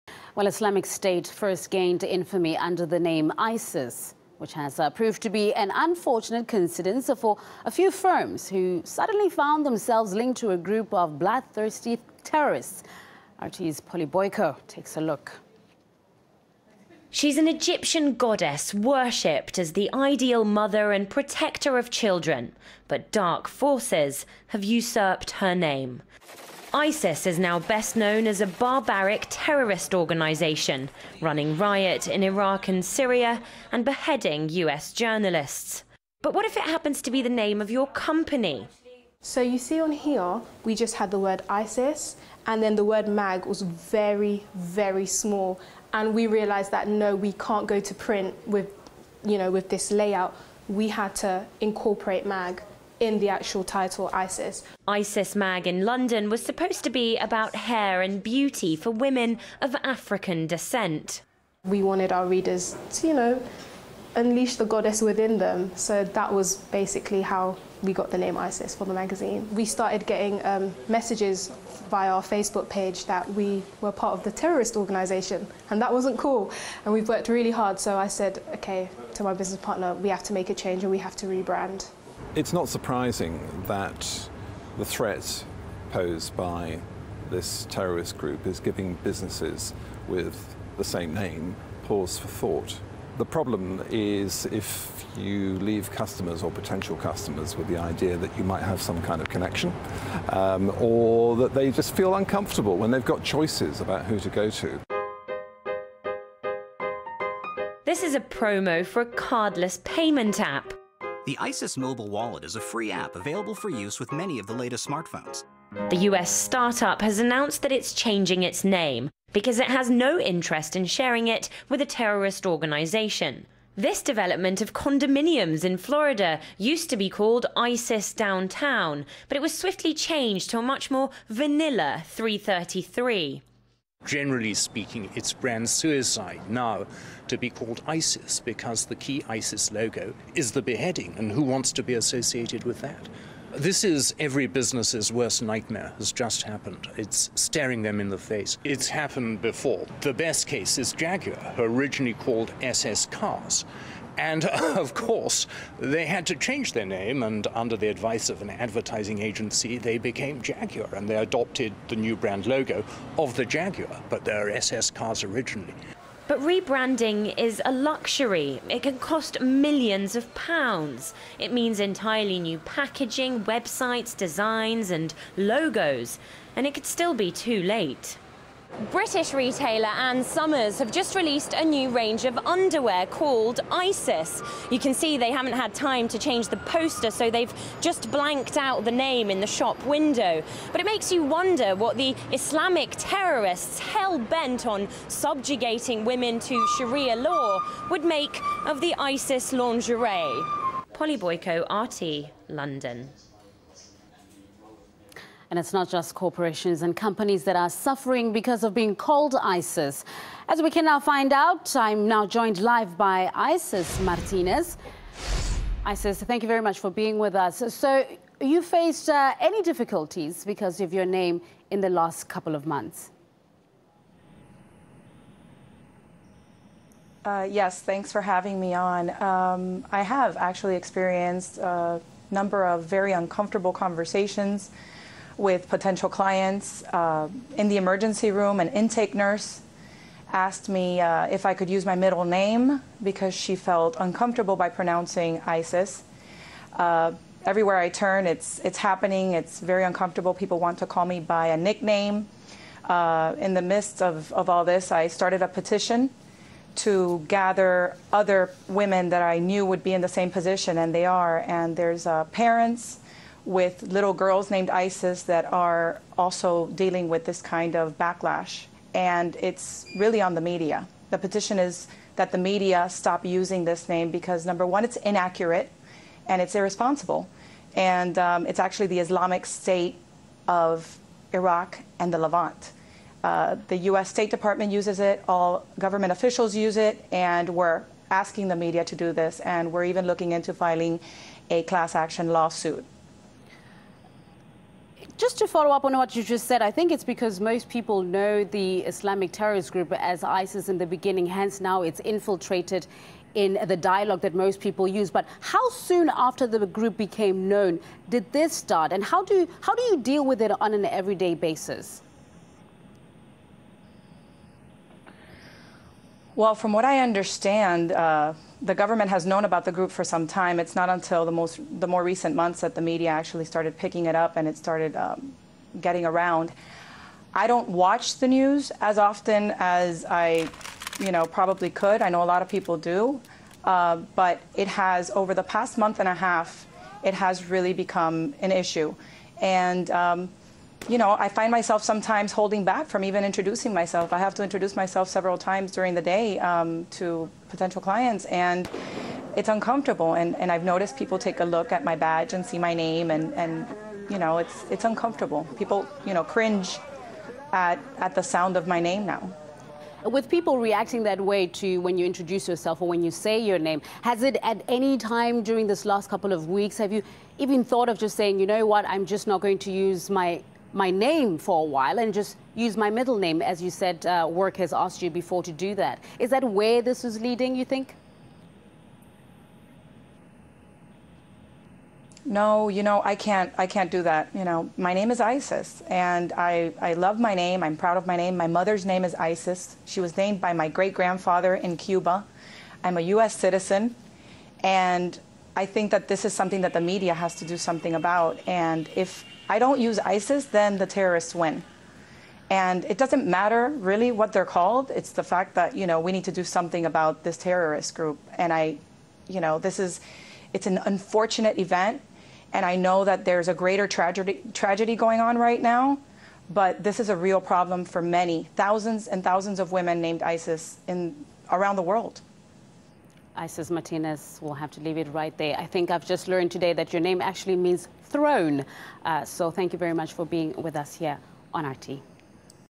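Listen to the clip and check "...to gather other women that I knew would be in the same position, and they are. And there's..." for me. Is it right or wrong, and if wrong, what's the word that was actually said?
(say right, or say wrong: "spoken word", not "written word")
right.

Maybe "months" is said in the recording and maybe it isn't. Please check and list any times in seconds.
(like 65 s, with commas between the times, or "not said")
222 s, 322 s, 335 s.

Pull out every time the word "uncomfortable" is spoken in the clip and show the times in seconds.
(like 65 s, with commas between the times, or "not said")
102 s, 233 s, 243 s, 249 s, 349 s, 354 s.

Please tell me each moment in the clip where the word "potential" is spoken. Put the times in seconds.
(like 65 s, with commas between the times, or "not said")
96 s, 235 s, 347 s.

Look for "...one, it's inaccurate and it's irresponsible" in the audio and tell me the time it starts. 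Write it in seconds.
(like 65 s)
274 s.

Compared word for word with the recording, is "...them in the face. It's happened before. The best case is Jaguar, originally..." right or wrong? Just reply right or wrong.
right.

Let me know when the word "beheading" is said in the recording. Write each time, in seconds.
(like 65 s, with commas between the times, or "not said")
33 s, 140 s.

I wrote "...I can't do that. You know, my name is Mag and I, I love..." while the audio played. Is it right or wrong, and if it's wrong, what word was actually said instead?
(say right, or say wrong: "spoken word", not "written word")
wrong: "Isis", not "Mag".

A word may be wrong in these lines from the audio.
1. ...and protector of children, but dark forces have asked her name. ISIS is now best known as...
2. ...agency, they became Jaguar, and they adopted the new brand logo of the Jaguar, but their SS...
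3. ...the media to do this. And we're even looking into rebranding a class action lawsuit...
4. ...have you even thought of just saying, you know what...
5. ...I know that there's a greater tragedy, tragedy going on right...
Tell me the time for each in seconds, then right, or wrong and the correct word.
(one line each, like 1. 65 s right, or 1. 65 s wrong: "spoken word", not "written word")
1. 20 s wrong: "usurped", not "asked"
2. 159 s right
3. 288 s wrong: "filing", not "rebranding"
4. 366 s right
5. 412 s right.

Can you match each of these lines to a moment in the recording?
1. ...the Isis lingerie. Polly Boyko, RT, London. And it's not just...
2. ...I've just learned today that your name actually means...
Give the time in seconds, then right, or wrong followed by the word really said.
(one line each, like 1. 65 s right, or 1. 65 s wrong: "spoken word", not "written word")
1. 198 s right
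2. 425 s right.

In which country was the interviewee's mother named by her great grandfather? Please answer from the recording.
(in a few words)
Cuba.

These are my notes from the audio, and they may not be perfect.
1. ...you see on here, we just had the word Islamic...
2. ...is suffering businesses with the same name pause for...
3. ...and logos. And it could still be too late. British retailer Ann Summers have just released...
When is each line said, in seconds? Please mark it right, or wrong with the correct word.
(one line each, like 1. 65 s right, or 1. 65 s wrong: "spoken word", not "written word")
1. 39 s wrong: "ISIS", not "Islamic"
2. 88 s wrong: "giving", not "suffering"
3. 174 s right.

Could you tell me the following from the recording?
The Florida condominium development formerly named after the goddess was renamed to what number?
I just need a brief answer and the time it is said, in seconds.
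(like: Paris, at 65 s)
333, at 132 s.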